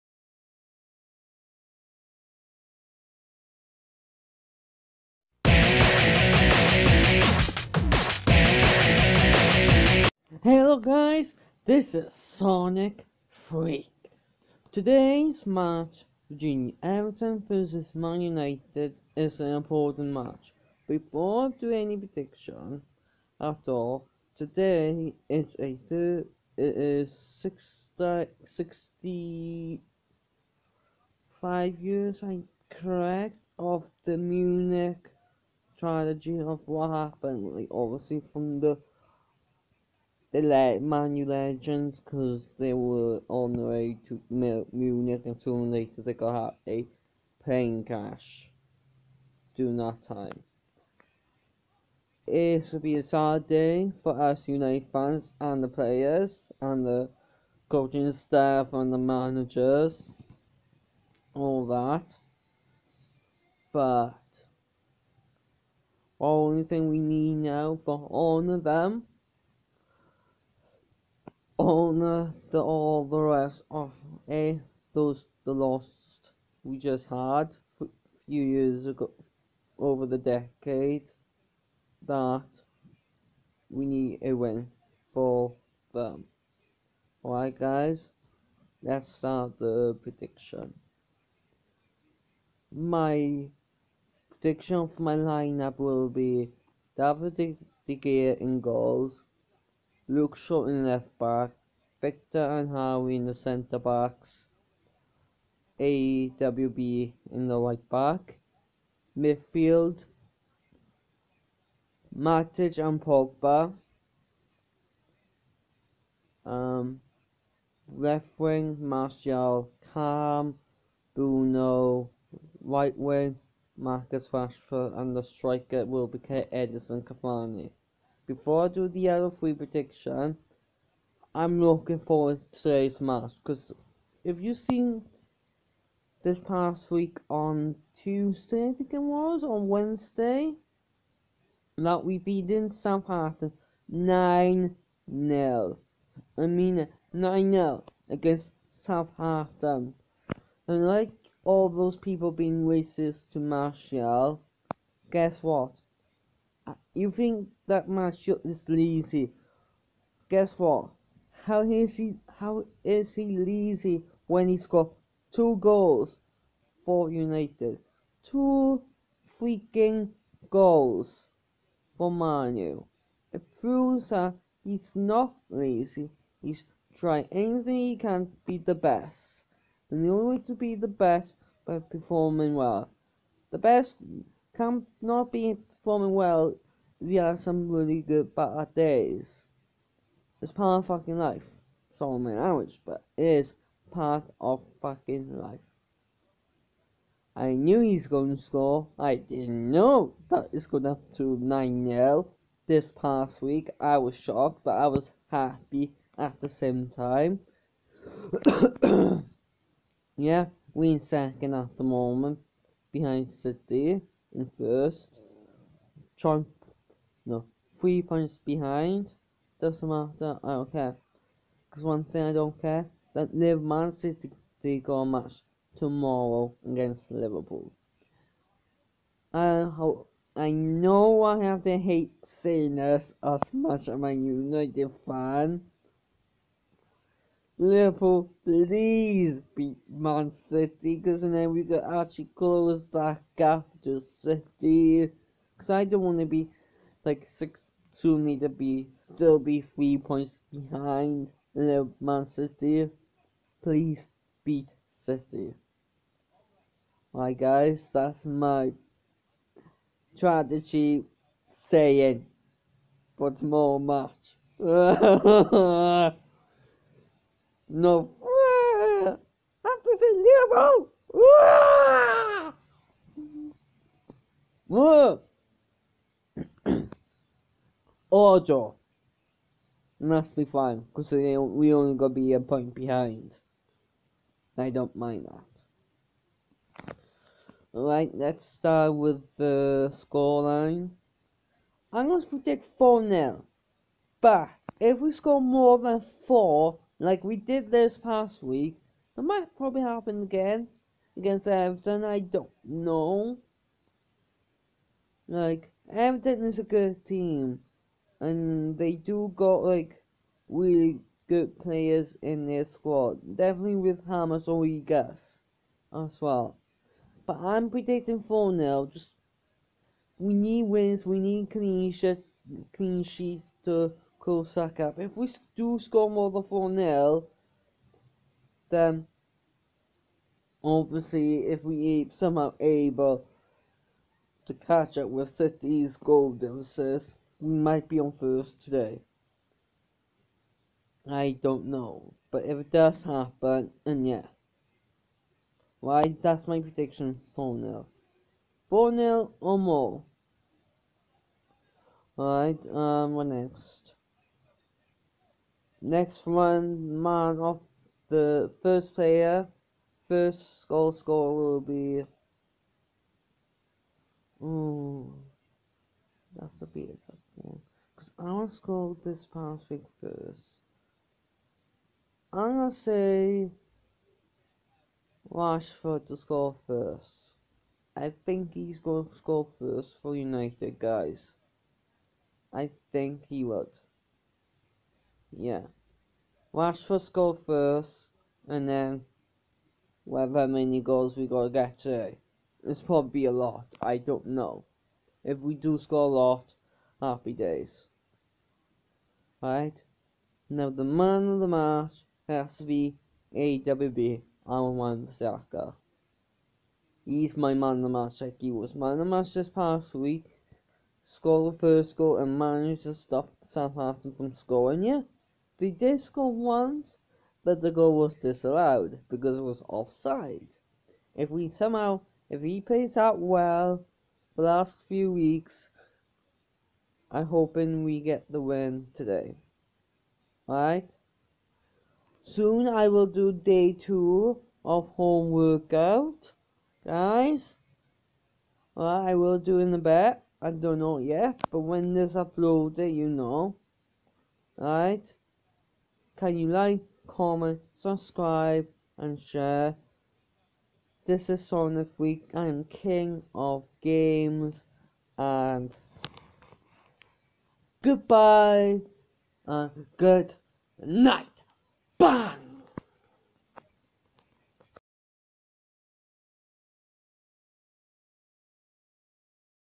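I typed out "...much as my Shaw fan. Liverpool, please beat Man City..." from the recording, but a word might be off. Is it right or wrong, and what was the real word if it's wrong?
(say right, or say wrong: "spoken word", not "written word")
wrong: "United", not "Shaw".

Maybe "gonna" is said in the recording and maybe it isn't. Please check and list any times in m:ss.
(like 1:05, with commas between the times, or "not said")
4:41, 6:12.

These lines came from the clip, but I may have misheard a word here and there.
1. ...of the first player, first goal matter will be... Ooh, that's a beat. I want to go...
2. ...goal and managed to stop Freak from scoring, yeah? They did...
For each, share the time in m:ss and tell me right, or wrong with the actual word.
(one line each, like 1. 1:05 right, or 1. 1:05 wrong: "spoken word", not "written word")
1. 5:57 wrong: "scorer", not "matter"
2. 6:51 wrong: "Southampton", not "Freak".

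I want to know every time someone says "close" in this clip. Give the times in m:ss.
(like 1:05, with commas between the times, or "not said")
4:02, 5:24.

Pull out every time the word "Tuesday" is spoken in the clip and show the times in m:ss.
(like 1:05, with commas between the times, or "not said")
2:17.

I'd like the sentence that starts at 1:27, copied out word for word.
Alright guys, let's start the prediction.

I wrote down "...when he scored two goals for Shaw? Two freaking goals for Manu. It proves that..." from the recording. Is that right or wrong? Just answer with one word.
wrong.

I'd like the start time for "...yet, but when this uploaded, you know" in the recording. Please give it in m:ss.
7:20.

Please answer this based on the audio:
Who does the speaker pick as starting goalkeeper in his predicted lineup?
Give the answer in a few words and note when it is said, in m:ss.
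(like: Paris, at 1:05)
David De Gea, at 1:36.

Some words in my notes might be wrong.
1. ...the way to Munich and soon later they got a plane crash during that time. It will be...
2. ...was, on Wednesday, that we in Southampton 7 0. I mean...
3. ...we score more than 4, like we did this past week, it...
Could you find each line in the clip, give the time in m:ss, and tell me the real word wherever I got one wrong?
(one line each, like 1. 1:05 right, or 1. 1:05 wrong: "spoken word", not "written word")
1. 0:43 right
2. 2:19 wrong: "9", not "7"
3. 4:54 right.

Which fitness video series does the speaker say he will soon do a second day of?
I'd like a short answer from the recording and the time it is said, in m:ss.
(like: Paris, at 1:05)
home workout, at 7:14.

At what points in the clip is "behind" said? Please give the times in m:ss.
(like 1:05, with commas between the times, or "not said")
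3:32, 3:38, 4:10, 4:42.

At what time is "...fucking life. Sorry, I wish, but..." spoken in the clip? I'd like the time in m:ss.
3:10.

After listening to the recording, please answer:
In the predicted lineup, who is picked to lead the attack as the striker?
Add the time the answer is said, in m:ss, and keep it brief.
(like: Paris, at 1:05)
Edinson Cavani, at 2:06.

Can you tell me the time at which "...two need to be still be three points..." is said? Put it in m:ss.
4:08.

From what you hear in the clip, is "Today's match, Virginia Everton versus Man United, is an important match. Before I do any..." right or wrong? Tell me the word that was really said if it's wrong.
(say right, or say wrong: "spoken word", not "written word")
right.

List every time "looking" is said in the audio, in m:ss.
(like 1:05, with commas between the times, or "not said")
2:11.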